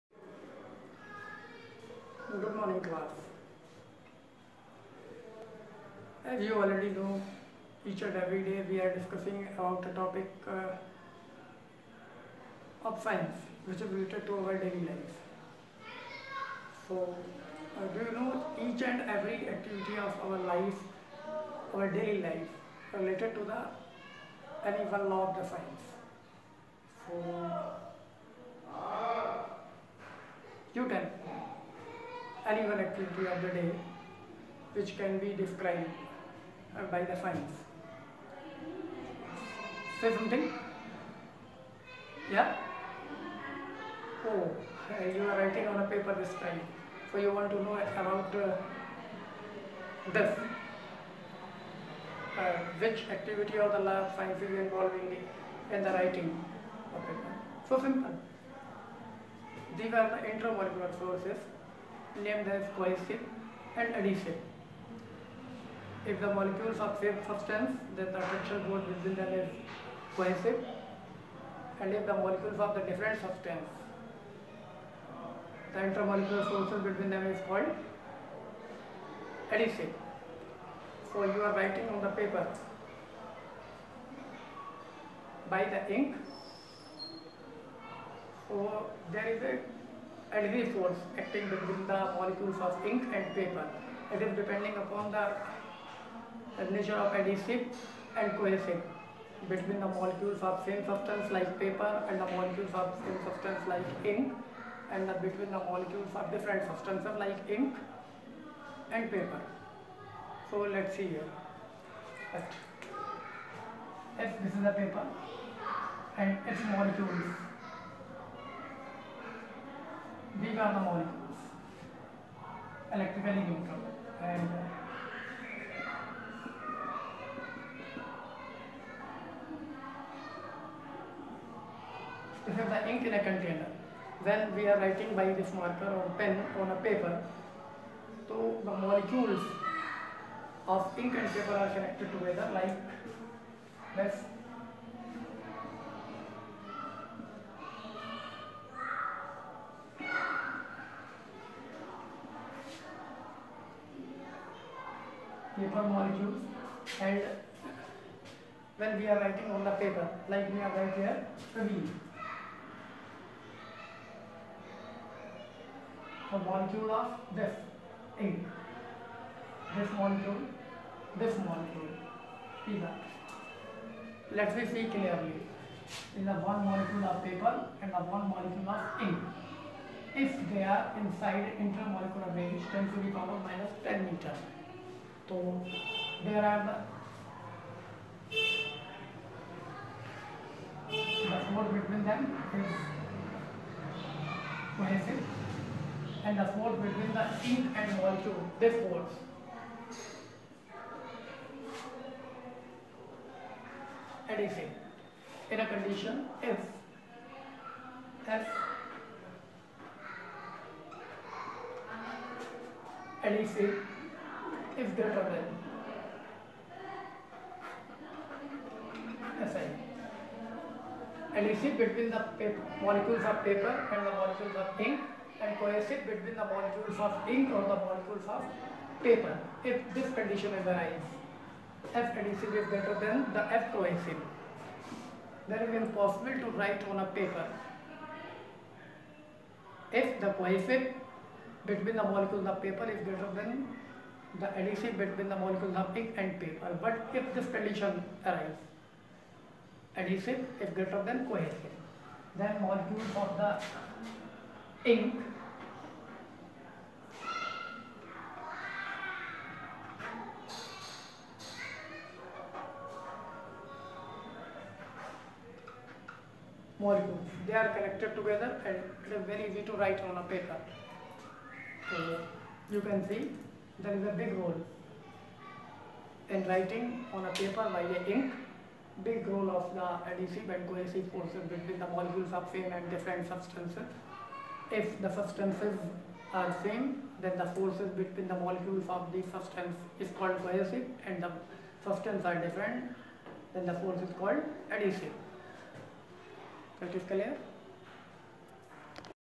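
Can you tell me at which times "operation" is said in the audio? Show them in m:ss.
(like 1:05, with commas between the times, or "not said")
not said.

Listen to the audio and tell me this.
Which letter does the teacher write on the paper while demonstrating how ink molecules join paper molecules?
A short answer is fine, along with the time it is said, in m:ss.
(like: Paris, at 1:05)
V, at 2:41.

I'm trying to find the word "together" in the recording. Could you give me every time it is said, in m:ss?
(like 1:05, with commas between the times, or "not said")
2:22, 4:28.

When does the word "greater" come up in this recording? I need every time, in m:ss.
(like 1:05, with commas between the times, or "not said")
3:34, 3:52, 4:03, 4:10.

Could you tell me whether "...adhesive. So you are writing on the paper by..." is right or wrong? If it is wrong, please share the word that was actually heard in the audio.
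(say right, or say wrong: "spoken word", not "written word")
right.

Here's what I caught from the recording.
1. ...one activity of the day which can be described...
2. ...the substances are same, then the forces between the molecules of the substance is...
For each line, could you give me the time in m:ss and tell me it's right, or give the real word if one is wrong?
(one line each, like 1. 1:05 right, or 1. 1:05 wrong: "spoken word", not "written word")
1. 0:32 right
2. 4:45 right.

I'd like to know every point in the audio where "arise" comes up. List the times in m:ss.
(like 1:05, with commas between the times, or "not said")
3:50, 4:08.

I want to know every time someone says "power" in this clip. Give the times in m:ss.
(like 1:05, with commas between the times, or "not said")
3:03.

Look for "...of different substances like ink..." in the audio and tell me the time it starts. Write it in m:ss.
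1:46.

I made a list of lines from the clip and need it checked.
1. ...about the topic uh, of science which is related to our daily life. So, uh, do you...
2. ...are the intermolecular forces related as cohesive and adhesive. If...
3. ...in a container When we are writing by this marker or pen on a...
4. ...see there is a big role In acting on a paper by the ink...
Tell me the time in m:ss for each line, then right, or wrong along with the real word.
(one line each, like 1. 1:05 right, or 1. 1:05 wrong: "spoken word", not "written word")
1. 0:09 right
2. 1:00 wrong: "named", not "related"
3. 2:13 right
4. 4:33 wrong: "writing", not "acting".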